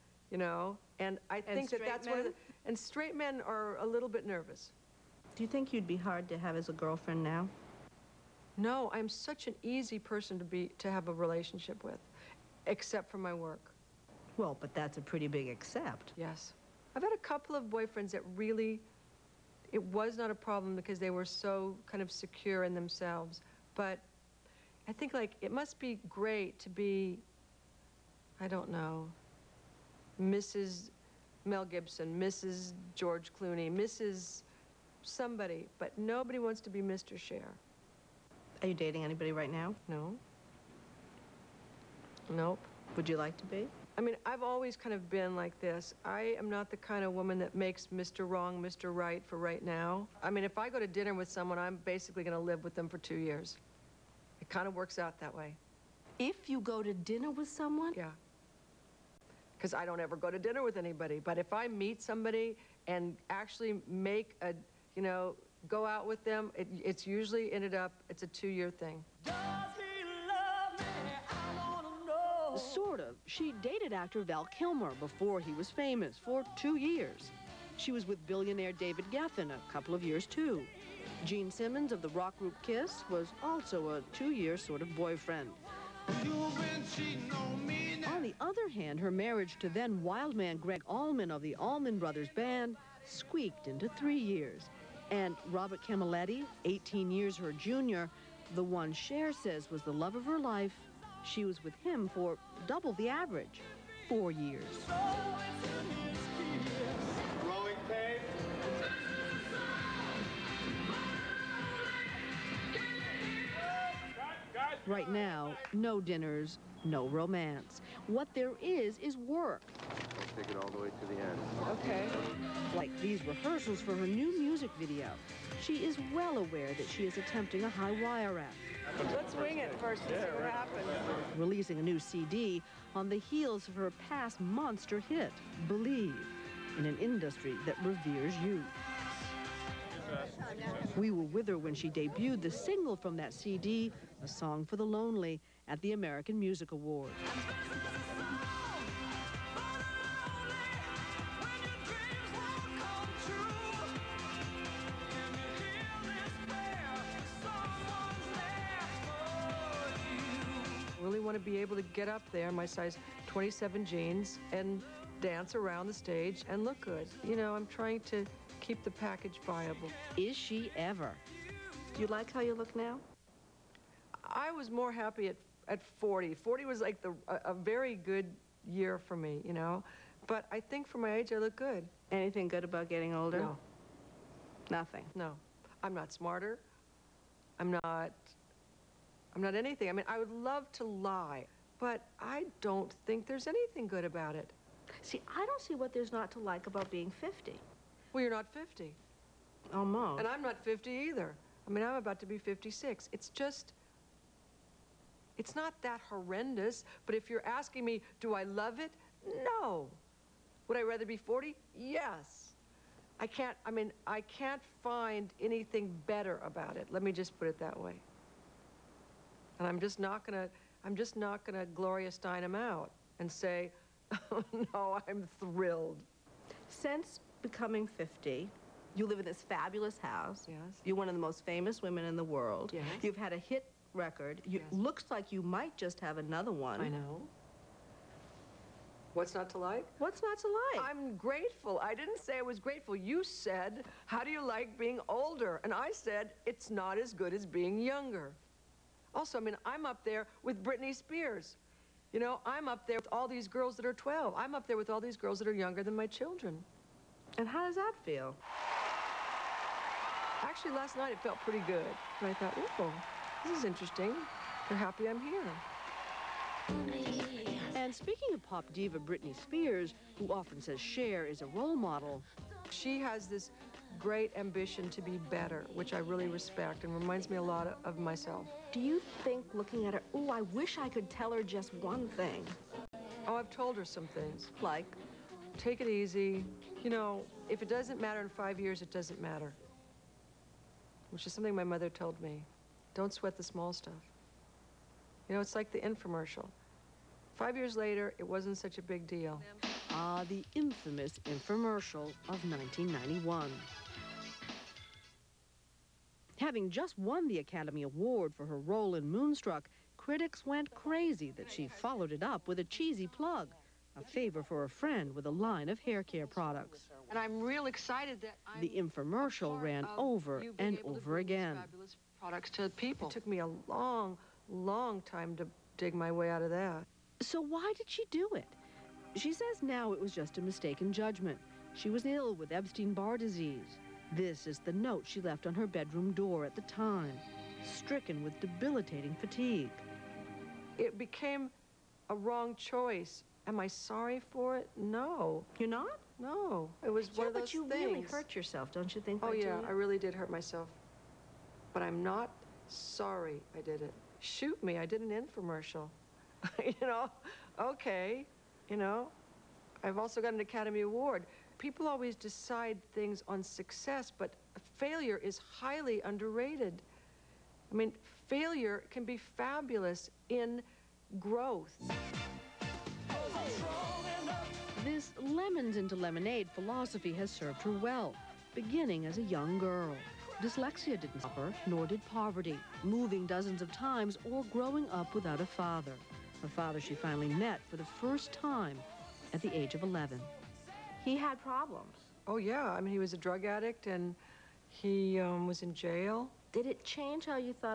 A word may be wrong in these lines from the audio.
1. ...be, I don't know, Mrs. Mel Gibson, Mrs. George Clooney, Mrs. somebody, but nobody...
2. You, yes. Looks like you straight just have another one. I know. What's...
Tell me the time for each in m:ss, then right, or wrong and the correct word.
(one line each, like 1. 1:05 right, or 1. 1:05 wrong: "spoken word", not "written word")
1. 0:26 right
2. 3:54 wrong: "might", not "straight".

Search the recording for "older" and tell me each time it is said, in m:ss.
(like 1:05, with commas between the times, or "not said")
3:03, 4:05.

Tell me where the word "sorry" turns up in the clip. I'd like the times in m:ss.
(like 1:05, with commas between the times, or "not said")
5:43, 5:52.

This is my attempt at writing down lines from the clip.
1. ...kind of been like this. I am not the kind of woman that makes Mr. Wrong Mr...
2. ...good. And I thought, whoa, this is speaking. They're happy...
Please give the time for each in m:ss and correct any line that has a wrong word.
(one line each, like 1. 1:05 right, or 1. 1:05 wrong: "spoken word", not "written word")
1. 0:44 right
2. 4:21 wrong: "interesting", not "speaking".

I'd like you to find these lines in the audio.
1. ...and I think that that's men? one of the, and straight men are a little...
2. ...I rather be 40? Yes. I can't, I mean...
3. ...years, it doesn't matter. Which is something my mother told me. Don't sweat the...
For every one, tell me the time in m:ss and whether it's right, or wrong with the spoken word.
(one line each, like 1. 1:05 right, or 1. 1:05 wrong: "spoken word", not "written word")
1. 0:00 right
2. 3:30 right
3. 4:48 right.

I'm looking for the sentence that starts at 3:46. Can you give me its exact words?
Since becoming 50, you live in this fabulous house.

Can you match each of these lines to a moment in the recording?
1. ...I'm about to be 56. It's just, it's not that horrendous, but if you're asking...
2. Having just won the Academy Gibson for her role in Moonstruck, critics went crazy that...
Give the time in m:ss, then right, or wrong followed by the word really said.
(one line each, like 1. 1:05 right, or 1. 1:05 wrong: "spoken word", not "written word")
1. 3:21 right
2. 5:06 wrong: "Award", not "Gibson".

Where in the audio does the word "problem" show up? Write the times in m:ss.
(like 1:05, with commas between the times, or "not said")
0:20, 6:31.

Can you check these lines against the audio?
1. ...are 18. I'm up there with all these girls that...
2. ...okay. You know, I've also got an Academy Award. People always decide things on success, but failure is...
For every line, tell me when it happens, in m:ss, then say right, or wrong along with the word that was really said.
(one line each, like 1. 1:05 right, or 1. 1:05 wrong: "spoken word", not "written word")
1. 4:13 wrong: "12", not "18"
2. 5:57 right.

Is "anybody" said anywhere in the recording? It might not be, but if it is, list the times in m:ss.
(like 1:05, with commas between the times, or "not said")
0:39, 1:00.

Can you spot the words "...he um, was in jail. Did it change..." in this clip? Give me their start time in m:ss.
6:34.